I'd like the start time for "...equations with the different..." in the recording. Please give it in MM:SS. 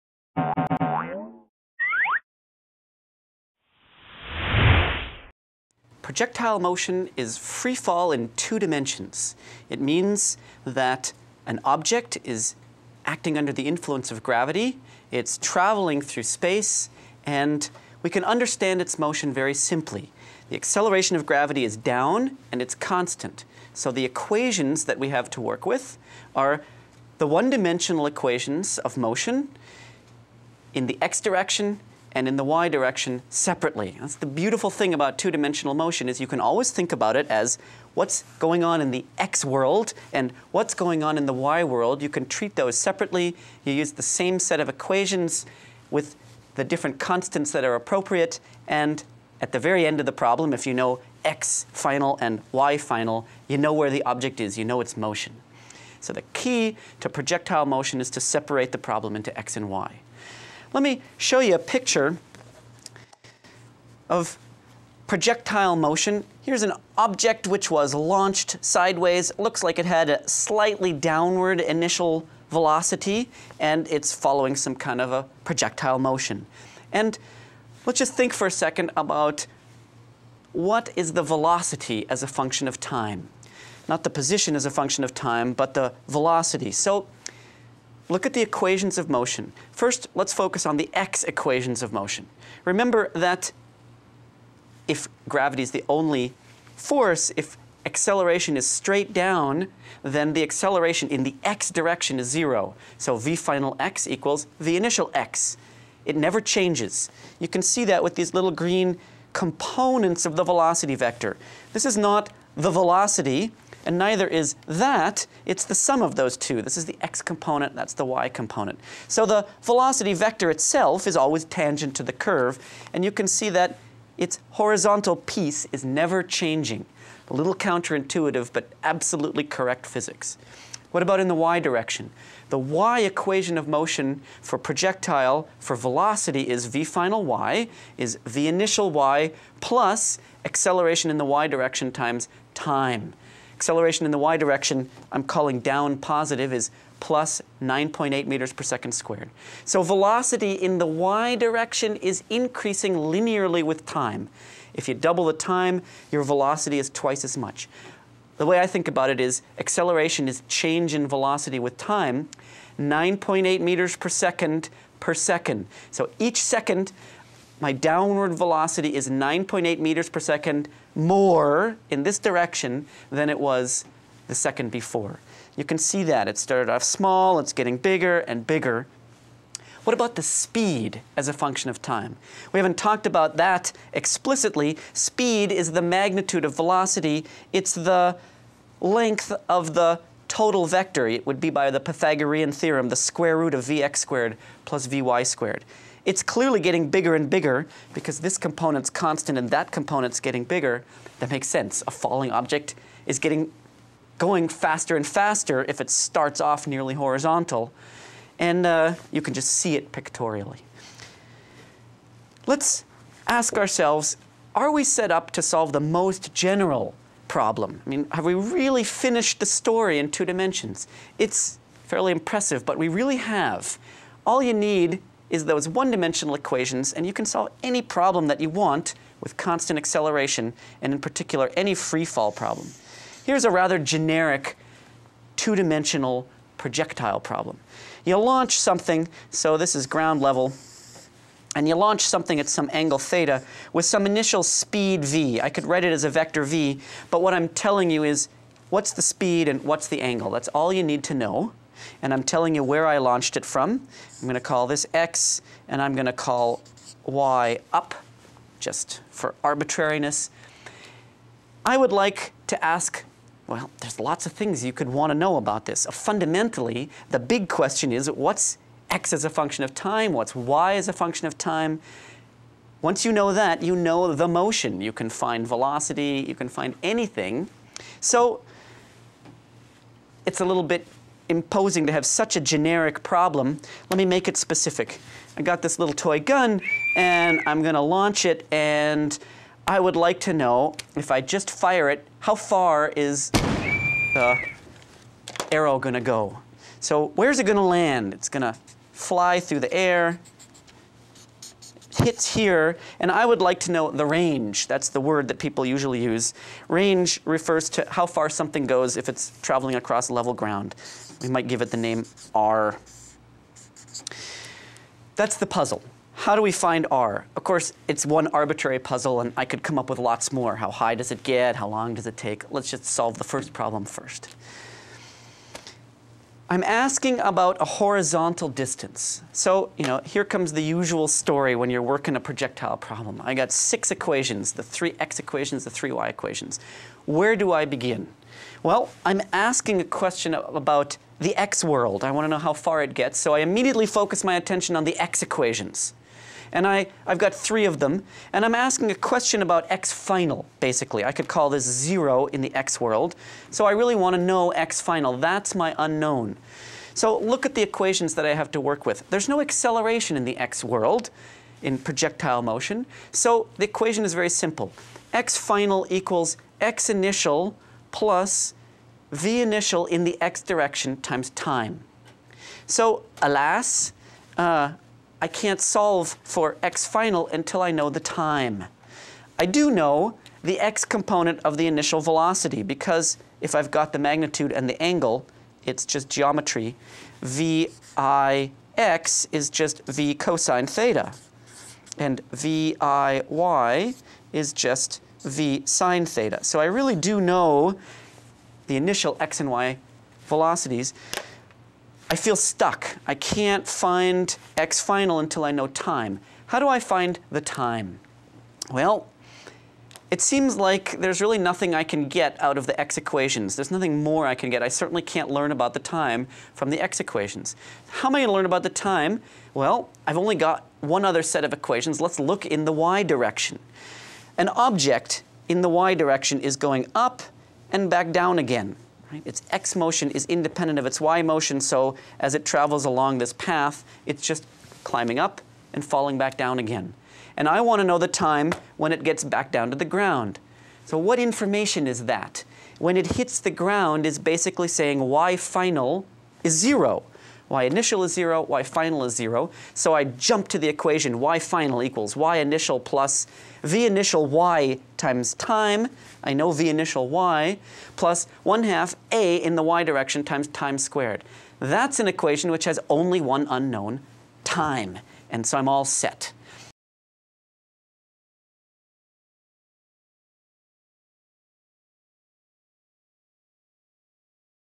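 00:44.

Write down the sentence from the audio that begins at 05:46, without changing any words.
And I, I've got three of them, and I'm asking a question about x final, basically.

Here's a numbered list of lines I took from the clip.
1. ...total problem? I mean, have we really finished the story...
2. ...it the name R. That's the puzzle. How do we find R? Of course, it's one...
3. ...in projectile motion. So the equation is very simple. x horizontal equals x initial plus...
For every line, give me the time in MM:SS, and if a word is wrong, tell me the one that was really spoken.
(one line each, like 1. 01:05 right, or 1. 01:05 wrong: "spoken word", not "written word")
1. 03:36 wrong: "general", not "total"
2. 05:11 right
3. 06:01 wrong: "final", not "horizontal".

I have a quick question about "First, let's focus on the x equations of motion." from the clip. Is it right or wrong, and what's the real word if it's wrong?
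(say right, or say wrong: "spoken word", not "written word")
right.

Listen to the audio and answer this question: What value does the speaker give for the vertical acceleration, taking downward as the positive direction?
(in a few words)
9.8 meters per second squared.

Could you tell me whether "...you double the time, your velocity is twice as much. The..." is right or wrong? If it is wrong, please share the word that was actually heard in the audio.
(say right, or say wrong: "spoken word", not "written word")
right.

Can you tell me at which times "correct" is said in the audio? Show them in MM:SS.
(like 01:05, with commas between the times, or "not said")
02:09.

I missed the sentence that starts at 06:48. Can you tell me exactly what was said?
Well, it seems like there's really nothing I can get out of the x equations.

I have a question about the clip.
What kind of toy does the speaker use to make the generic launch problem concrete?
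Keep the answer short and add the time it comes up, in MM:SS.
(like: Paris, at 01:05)
toy gun, at 04:45.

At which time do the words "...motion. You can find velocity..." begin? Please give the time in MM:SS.
04:34.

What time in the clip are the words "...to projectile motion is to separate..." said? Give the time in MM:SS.
00:56.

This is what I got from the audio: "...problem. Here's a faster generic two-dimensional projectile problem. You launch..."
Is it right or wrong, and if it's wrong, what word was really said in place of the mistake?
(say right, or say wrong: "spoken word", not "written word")
wrong: "rather", not "faster".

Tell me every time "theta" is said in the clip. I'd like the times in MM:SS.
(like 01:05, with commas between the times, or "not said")
04:02, 06:30, 06:36.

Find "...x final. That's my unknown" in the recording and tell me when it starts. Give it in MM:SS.
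05:54.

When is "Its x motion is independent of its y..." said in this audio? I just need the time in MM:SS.
07:09.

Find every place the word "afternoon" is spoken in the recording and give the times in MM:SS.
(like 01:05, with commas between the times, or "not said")
not said.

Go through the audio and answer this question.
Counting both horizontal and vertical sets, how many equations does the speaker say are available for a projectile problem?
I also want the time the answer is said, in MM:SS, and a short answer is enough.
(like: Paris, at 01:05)
6, at 05:33.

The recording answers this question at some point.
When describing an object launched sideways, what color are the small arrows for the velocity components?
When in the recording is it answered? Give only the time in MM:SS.
01:48.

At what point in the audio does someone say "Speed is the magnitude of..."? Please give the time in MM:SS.
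03:04.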